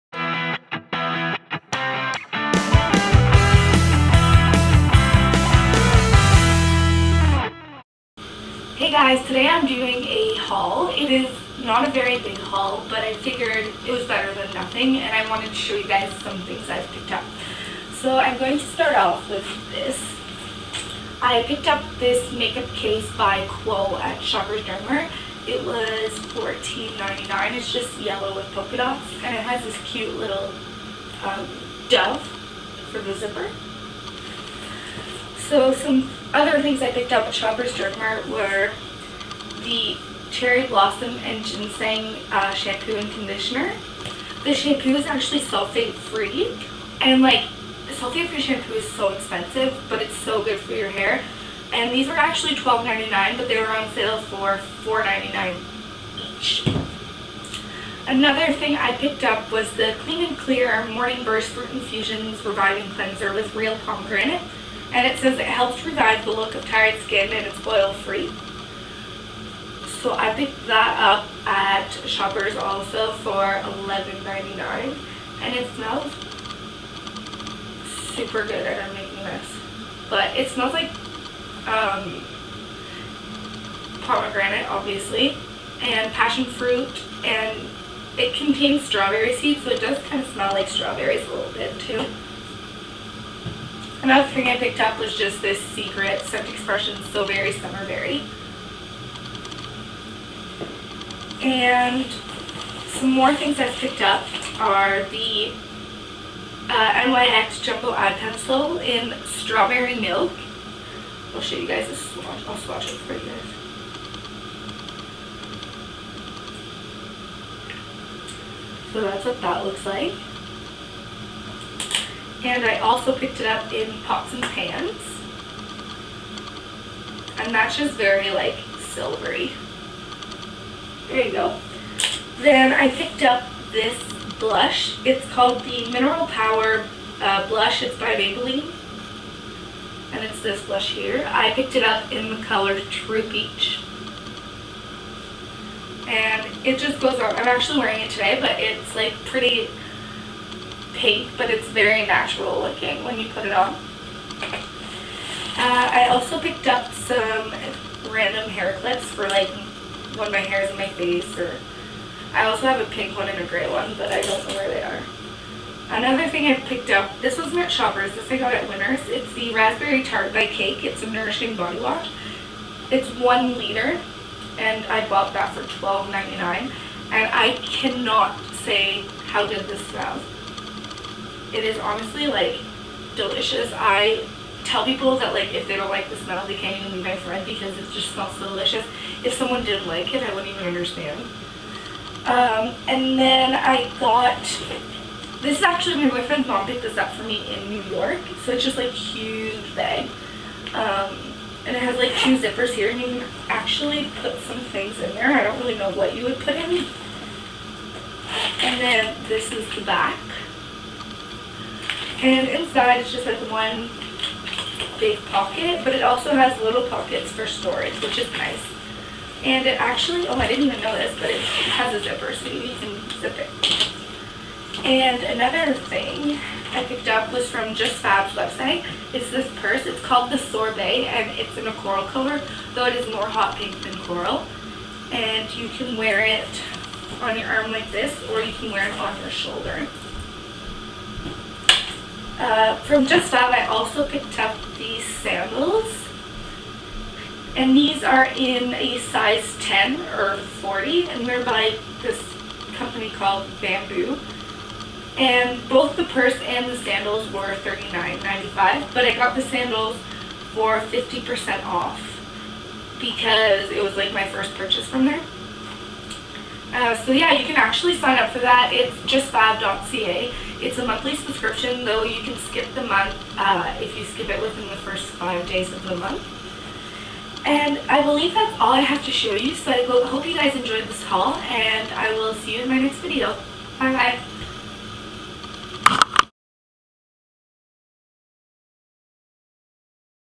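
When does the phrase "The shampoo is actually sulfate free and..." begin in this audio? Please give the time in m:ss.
0:44.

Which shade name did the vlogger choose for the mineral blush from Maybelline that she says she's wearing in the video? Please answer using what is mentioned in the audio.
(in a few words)
True Peach.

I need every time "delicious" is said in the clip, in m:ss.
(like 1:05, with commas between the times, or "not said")
3:03, 3:08.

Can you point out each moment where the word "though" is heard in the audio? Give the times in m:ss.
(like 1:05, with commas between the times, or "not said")
3:52, 4:31.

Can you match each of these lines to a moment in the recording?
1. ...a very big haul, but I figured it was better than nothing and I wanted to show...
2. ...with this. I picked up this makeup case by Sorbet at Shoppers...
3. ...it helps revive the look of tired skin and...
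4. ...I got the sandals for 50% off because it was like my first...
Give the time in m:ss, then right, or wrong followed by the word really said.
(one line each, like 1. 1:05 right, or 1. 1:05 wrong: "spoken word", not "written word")
1. 0:11 right
2. 0:19 wrong: "Quo", not "Sorbet"
3. 1:05 right
4. 4:19 right.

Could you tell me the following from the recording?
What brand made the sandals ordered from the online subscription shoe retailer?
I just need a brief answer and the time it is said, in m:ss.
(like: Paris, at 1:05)
Bamboo, at 4:13.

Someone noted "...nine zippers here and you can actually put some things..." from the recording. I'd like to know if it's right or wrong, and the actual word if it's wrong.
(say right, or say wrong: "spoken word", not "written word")
wrong: "two", not "nine".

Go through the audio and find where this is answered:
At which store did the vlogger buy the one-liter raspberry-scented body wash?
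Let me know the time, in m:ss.
2:48.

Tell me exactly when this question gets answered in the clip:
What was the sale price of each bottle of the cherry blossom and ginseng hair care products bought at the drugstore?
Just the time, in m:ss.
0:54.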